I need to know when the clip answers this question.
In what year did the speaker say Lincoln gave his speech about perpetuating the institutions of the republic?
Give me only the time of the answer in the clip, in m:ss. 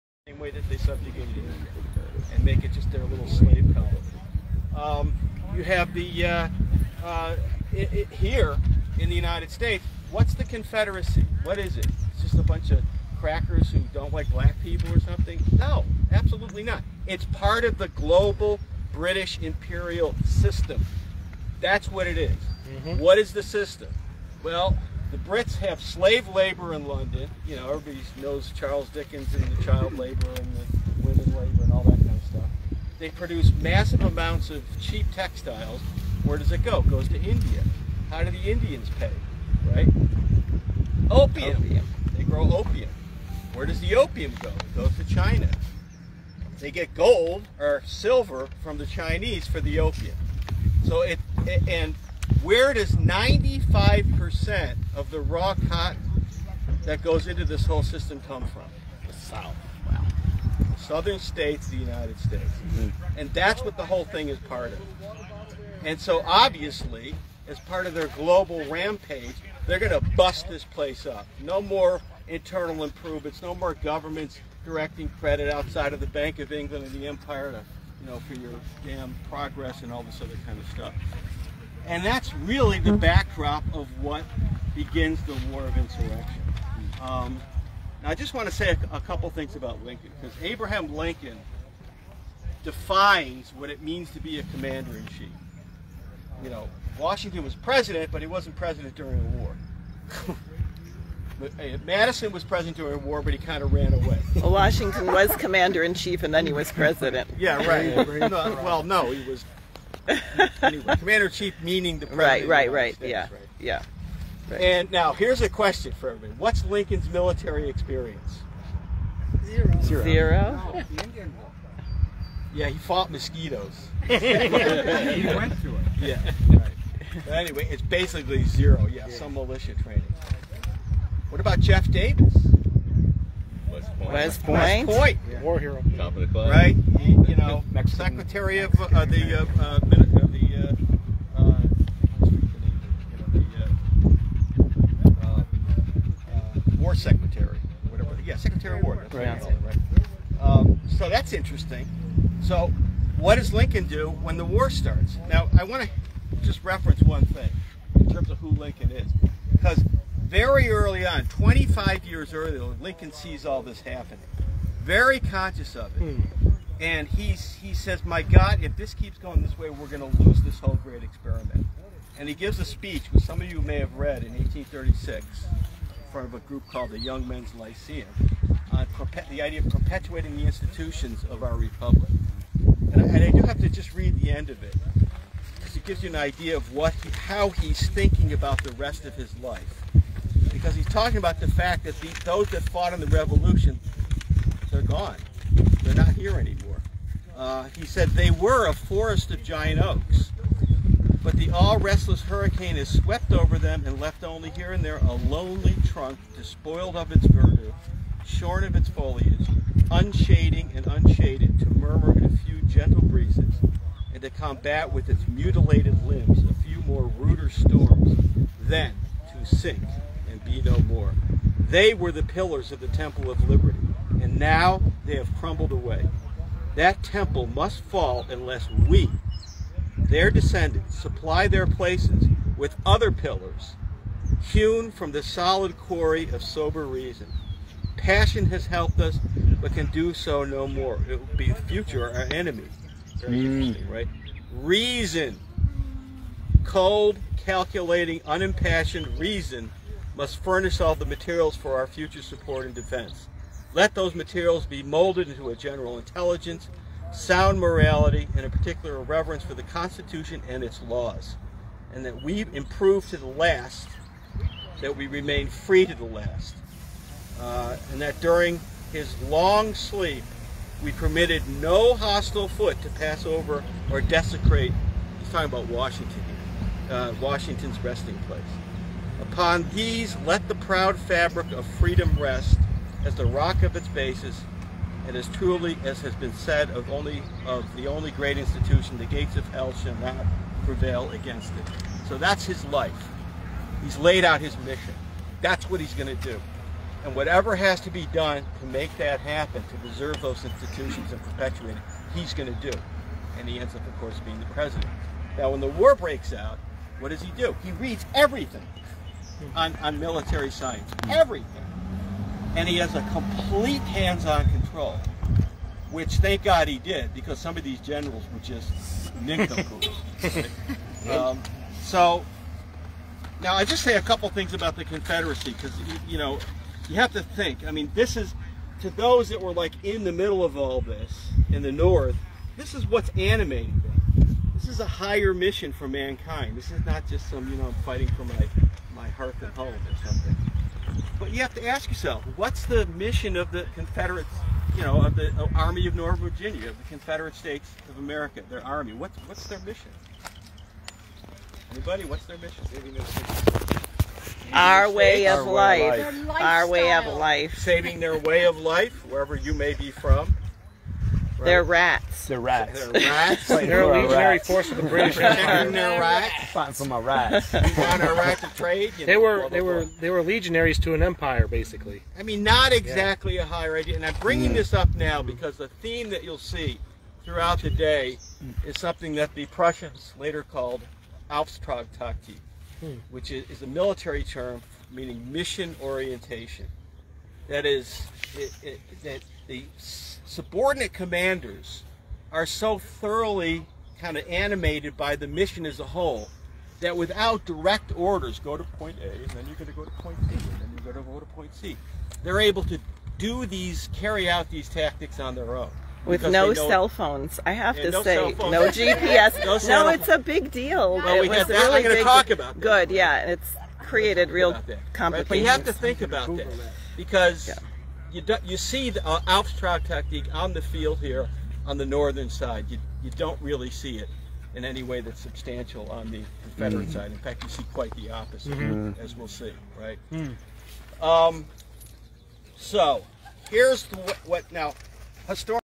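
2:54.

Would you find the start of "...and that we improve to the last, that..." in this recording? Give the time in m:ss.
4:21.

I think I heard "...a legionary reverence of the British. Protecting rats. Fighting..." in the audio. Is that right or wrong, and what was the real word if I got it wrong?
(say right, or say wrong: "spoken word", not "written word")
wrong: "force", not "reverence".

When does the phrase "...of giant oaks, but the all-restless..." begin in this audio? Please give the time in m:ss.
3:19.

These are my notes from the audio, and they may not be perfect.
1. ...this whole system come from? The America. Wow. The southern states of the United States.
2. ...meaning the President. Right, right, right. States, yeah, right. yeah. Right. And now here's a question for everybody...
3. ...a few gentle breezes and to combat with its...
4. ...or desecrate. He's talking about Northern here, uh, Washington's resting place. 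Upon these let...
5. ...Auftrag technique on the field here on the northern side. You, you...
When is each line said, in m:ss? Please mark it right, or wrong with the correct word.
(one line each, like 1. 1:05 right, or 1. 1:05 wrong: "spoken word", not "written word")
1. 0:57 wrong: "South", not "America"
2. 1:51 right
3. 3:32 right
4. 4:33 wrong: "Washington", not "Northern"
5. 6:59 right.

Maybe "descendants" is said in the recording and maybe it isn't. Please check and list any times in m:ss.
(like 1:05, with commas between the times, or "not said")
3:50.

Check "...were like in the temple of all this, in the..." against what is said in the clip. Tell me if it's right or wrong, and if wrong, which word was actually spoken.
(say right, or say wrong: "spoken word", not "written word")
wrong: "middle", not "temple".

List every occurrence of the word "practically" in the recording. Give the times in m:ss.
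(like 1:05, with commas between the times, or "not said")
not said.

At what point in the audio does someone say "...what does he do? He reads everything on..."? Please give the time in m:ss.
5:06.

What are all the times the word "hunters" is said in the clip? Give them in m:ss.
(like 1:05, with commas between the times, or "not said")
not said.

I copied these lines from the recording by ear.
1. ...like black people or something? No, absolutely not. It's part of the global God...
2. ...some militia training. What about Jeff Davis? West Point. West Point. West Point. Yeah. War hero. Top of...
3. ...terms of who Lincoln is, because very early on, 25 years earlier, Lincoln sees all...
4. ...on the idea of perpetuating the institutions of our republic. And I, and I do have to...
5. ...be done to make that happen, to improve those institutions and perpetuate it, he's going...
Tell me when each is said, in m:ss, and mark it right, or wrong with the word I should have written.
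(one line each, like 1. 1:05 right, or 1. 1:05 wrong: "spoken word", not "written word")
1. 0:14 wrong: "British", not "God"
2. 2:09 right
3. 2:38 right
4. 2:58 right
5. 4:57 wrong: "preserve", not "improve".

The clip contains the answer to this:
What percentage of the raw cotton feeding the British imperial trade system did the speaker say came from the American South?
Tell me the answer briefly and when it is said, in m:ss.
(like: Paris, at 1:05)
95%, at 0:52.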